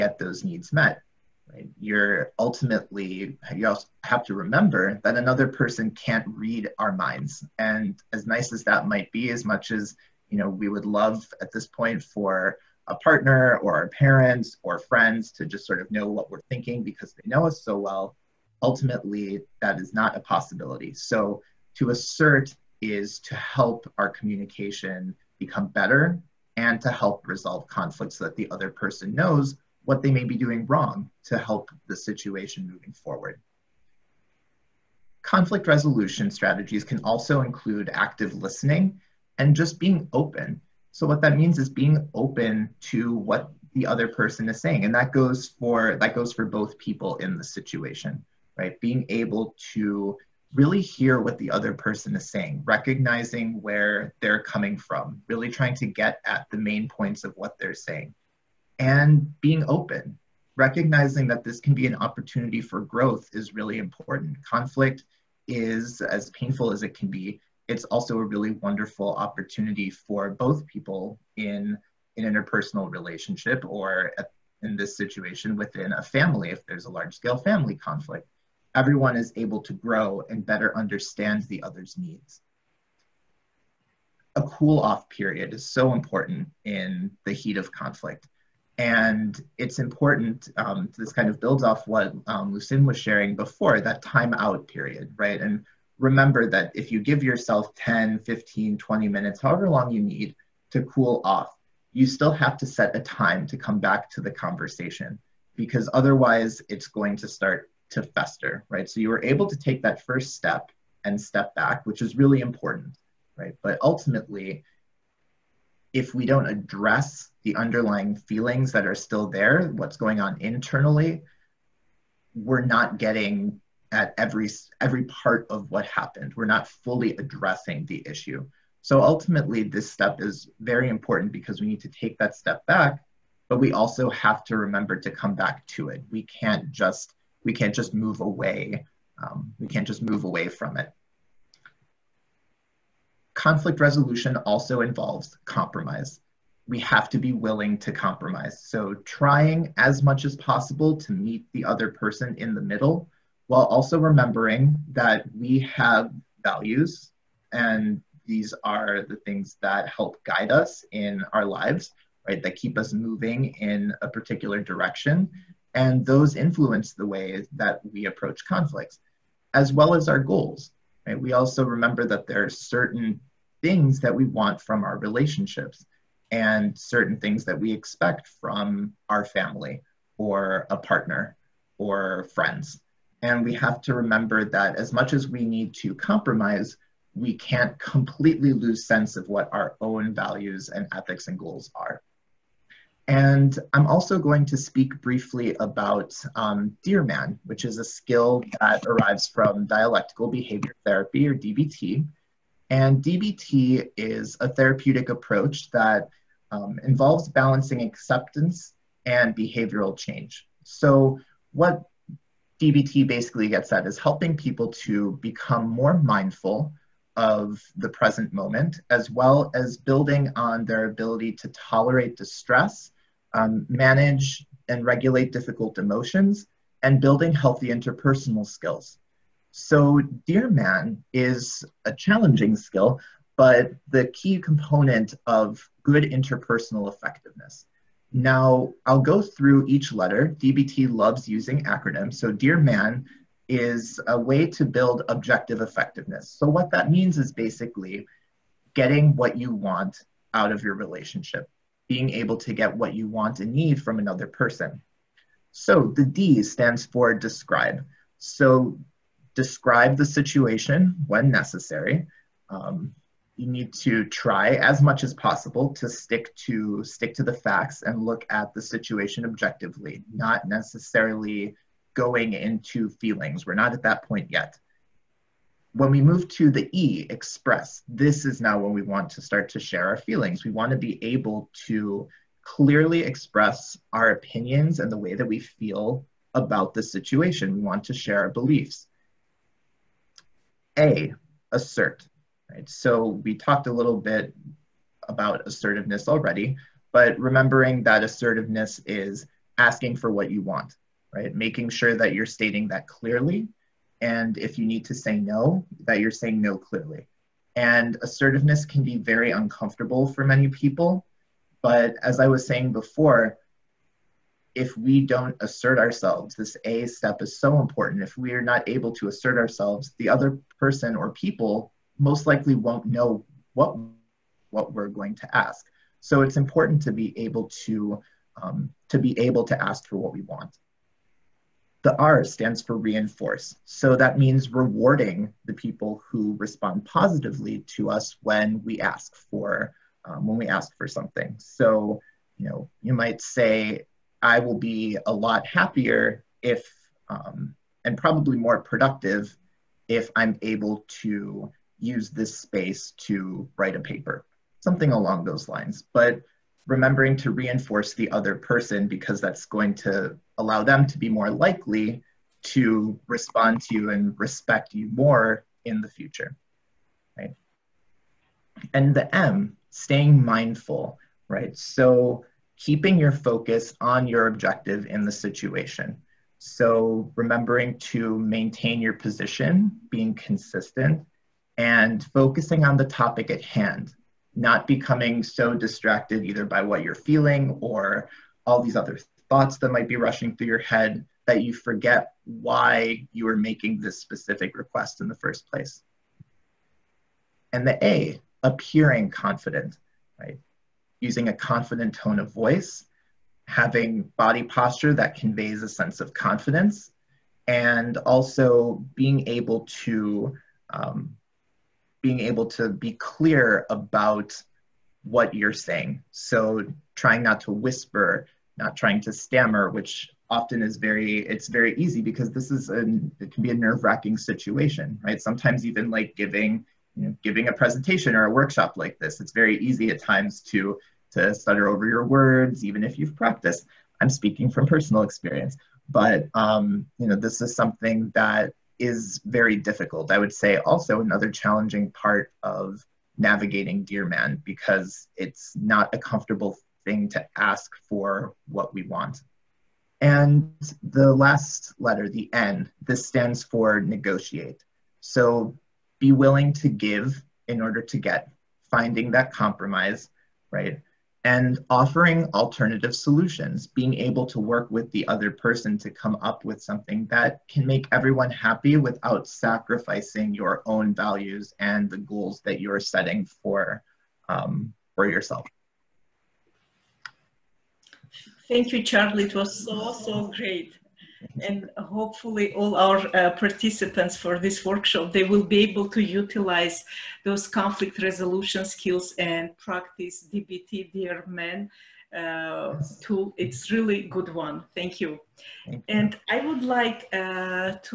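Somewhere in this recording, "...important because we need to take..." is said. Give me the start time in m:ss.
2:10.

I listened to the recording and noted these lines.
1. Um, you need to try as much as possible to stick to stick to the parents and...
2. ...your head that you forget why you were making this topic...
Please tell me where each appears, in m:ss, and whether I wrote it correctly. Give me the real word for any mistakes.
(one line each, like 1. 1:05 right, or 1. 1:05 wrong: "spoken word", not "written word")
1. 4:22 wrong: "facts", not "parents"
2. 6:30 wrong: "specific", not "topic".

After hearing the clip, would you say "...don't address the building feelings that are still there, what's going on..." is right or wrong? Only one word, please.
wrong.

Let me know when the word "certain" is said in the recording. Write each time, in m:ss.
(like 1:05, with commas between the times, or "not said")
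2:52, 2:56.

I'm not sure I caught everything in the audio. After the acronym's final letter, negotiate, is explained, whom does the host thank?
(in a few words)
Charlie.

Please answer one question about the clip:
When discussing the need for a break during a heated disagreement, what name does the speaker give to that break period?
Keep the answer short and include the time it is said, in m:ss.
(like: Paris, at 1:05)
Cool off period, at 1:24.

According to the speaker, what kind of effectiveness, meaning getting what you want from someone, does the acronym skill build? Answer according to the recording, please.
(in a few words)
Objective effectiveness.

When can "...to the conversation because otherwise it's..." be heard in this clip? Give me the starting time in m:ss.
1:44.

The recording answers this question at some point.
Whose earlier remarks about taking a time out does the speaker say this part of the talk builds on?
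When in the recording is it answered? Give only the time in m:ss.
1:32.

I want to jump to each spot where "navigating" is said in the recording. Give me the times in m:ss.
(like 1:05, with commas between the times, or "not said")
7:23.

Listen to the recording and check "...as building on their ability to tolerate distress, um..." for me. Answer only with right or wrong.
right.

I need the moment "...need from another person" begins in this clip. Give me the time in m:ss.
4:13.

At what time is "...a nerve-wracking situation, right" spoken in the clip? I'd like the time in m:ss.
7:03.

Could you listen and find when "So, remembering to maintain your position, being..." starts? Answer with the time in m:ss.
6:16.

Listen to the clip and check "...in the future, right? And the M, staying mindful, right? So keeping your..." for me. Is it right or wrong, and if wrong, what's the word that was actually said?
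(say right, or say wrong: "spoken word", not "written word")
right.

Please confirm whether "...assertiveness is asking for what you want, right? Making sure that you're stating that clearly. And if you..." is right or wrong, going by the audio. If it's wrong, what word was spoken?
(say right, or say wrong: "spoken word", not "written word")
right.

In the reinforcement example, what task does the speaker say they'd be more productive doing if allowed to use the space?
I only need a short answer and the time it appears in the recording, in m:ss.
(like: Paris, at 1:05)
Write a paper, at 5:53.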